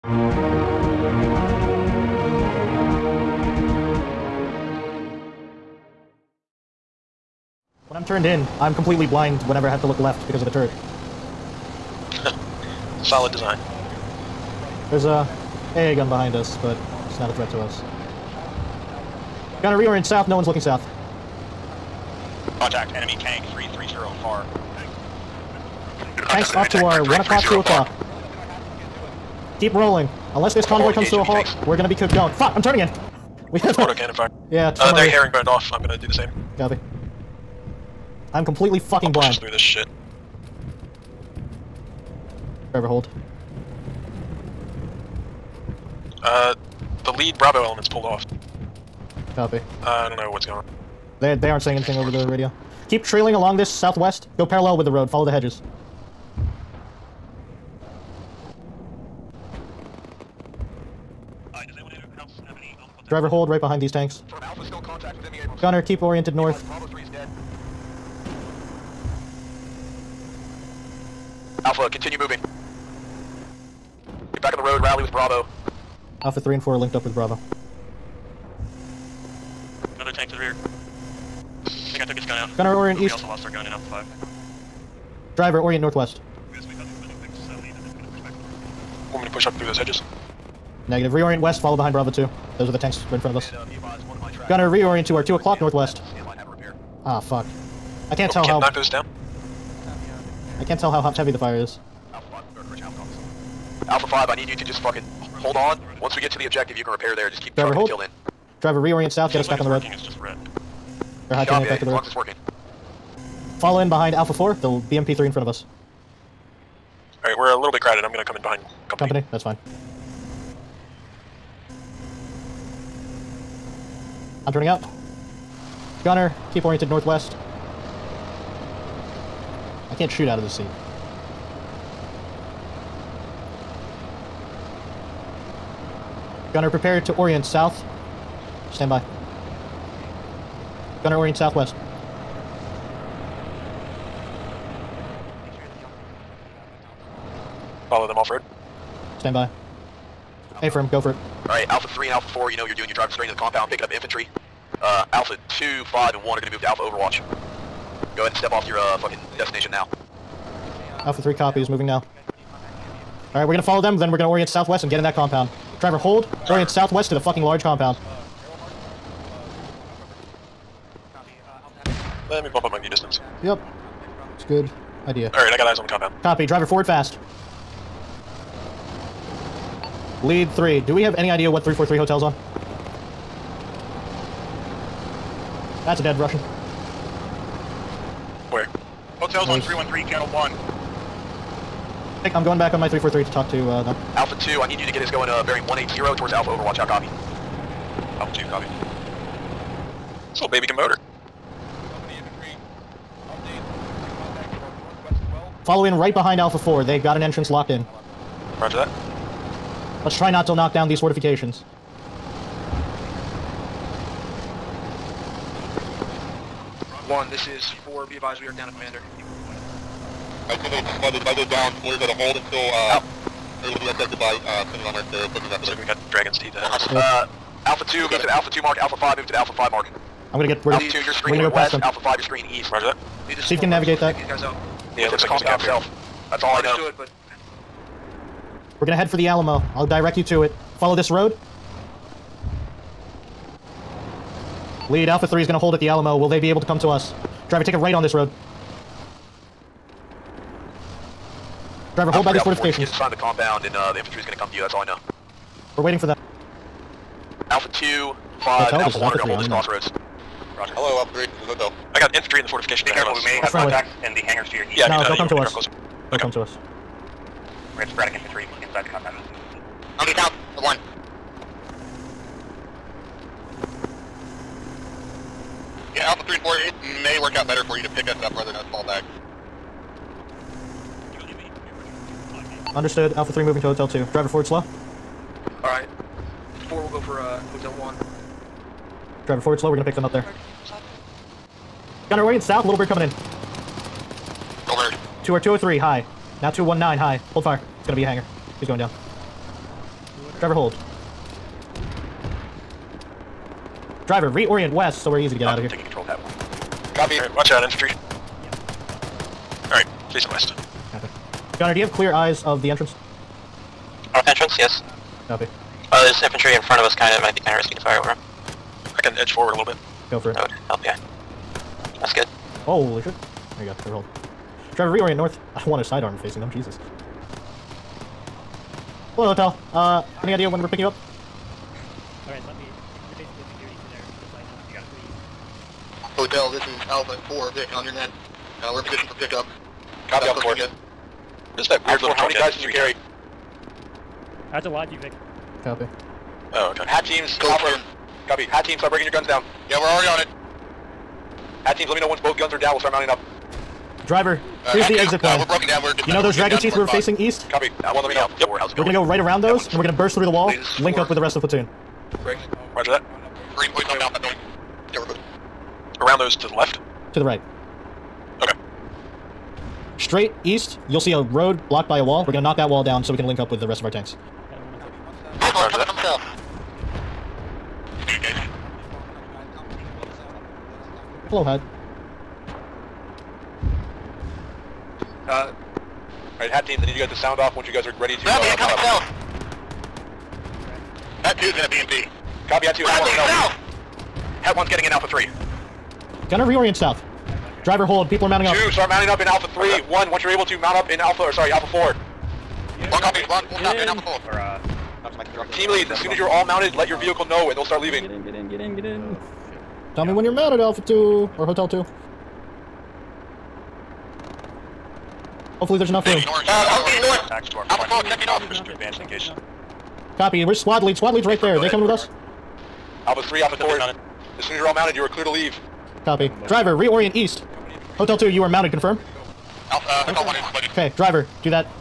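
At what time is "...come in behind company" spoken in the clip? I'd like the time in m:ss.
1:58.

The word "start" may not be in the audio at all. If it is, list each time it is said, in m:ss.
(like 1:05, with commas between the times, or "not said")
5:48, 5:52, 6:38, 6:47.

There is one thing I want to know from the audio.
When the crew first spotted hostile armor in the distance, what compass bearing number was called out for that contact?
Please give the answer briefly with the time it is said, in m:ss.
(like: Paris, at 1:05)
330, at 0:22.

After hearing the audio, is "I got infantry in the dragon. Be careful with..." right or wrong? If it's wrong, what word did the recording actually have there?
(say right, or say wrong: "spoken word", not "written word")
wrong: "fortification", not "dragon".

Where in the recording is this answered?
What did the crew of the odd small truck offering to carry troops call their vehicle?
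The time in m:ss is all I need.
5:44.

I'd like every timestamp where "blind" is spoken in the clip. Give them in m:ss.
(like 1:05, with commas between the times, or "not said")
0:09, 0:39.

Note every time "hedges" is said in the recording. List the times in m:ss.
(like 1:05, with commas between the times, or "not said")
0:55, 1:29.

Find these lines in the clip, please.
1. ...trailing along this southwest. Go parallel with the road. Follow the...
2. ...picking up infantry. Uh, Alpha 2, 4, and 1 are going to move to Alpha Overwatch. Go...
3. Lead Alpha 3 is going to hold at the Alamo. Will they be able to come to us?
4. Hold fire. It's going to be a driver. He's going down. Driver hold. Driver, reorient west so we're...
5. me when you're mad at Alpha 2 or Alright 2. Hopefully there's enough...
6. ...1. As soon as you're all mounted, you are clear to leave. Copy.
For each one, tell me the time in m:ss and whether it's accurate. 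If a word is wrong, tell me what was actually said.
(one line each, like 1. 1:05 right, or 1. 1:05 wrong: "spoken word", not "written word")
1. 0:53 right
2. 2:33 wrong: "5", not "4"
3. 4:04 right
4. 4:57 wrong: "hanger", not "driver"
5. 6:50 wrong: "Hotel", not "Alright"
6. 7:03 wrong: "4", not "1".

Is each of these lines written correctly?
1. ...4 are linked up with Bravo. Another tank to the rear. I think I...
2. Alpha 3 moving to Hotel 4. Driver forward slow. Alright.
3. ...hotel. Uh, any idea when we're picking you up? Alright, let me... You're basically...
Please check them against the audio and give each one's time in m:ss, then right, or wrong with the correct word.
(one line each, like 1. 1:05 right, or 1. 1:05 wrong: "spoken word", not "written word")
1. 1:16 right
2. 4:43 wrong: "2", not "4"
3. 5:29 right.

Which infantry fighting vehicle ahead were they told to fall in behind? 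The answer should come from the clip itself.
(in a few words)
BMP-3.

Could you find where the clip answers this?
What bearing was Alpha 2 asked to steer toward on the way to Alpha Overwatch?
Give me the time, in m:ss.
3:15.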